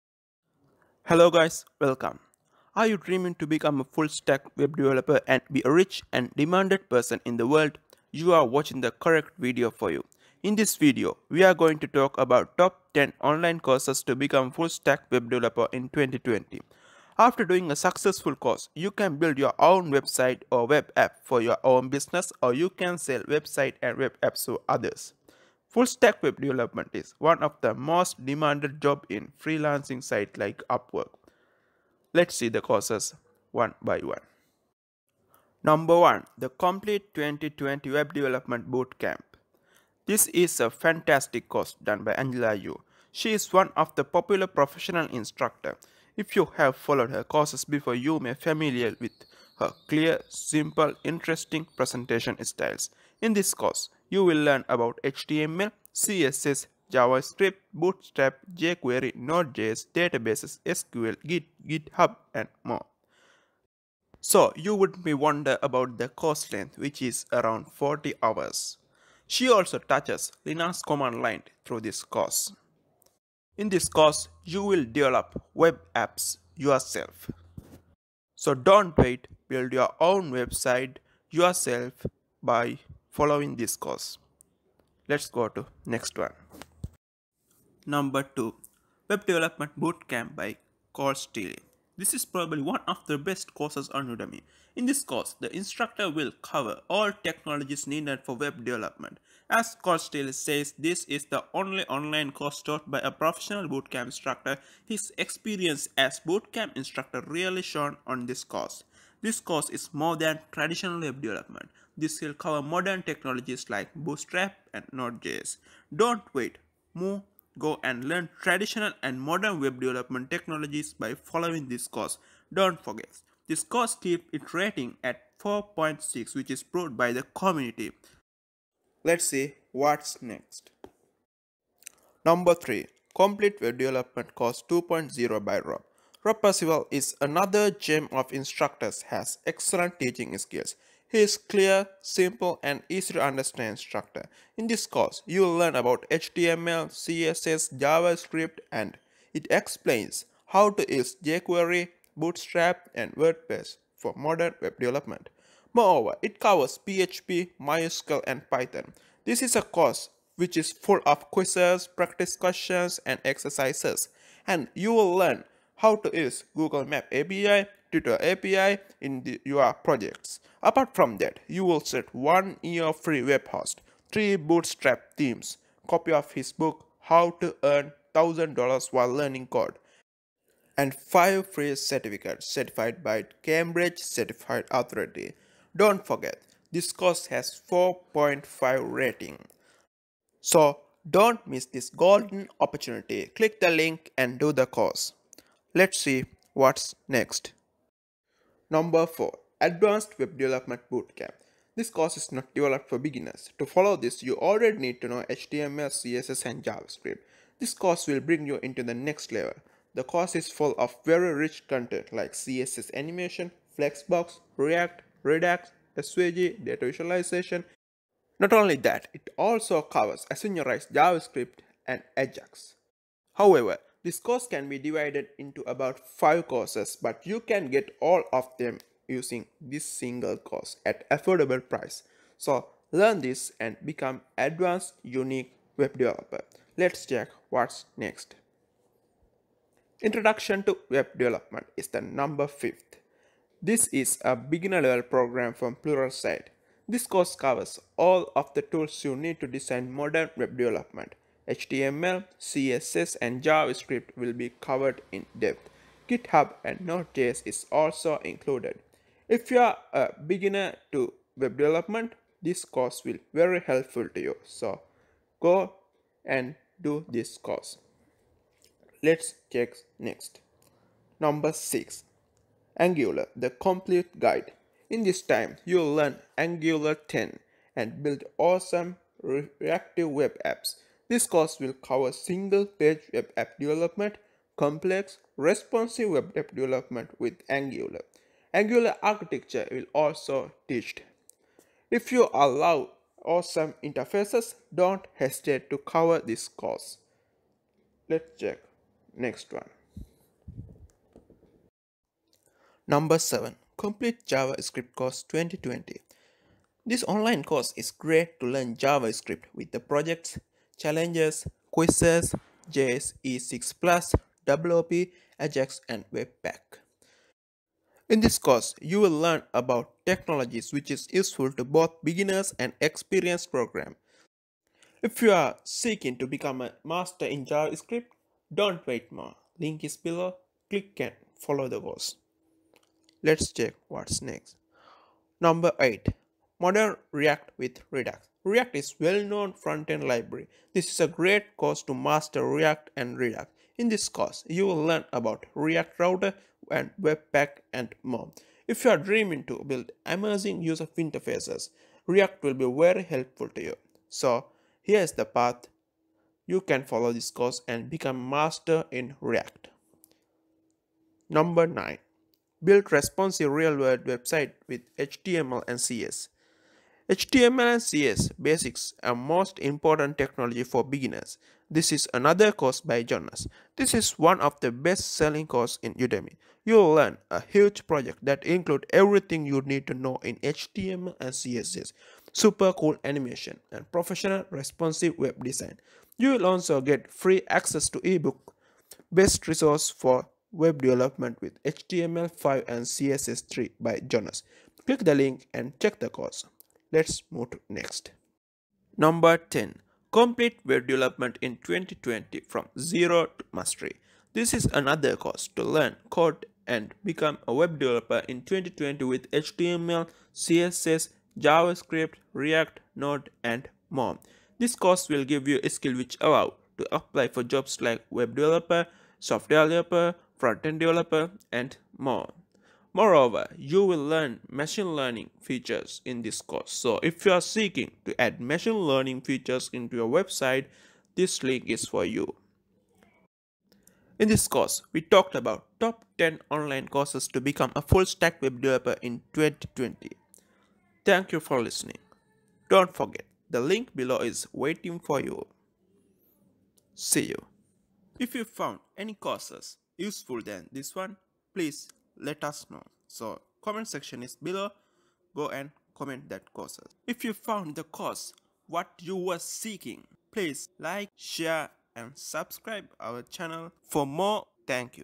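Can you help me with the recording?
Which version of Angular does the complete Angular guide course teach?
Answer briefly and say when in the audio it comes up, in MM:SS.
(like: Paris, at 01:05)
Angular 10, at 04:36.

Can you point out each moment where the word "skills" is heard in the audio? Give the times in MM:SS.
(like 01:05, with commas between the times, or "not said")
02:20, 06:55.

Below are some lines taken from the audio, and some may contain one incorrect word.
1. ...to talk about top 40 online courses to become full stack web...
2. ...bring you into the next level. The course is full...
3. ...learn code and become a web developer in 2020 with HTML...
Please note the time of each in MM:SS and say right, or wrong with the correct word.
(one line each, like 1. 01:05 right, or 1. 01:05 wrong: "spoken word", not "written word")
1. 00:11 wrong: "10", not "40"
2. 03:28 right
3. 06:45 right.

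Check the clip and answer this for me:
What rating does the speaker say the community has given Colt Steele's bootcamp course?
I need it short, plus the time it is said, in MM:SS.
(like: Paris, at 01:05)
4.6, at 02:05.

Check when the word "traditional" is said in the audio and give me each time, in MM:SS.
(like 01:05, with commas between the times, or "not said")
01:50, 01:58.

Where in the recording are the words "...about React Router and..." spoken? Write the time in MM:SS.
05:45.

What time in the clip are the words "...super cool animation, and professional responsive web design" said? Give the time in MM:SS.
06:22.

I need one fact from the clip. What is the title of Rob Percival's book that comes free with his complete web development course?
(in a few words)
How to Earn $1000 while learning code.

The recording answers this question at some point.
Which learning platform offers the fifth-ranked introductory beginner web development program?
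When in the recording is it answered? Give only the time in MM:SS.
04:05.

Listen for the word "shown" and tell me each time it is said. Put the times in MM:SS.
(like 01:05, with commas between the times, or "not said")
01:47.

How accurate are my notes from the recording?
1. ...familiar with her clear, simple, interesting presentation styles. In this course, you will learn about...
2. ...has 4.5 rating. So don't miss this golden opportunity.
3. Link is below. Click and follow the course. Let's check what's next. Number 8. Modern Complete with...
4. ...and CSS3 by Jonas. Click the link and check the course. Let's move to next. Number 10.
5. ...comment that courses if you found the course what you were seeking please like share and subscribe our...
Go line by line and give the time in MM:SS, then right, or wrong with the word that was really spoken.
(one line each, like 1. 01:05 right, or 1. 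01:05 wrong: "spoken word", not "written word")
1. 00:48 right
2. 03:07 right
3. 05:29 wrong: "React", not "Complete"
4. 06:32 right
5. 07:35 right.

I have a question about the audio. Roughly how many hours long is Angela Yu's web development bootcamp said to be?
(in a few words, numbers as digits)
40 hours.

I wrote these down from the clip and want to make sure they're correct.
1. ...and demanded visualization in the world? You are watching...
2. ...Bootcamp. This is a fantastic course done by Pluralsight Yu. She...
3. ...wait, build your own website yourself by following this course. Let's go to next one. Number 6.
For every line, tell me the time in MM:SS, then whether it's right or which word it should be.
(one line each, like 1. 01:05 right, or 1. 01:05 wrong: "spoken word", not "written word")
1. 00:06 wrong: "person", not "visualization"
2. 00:38 wrong: "Angela", not "Pluralsight"
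3. 01:18 wrong: "2", not "6".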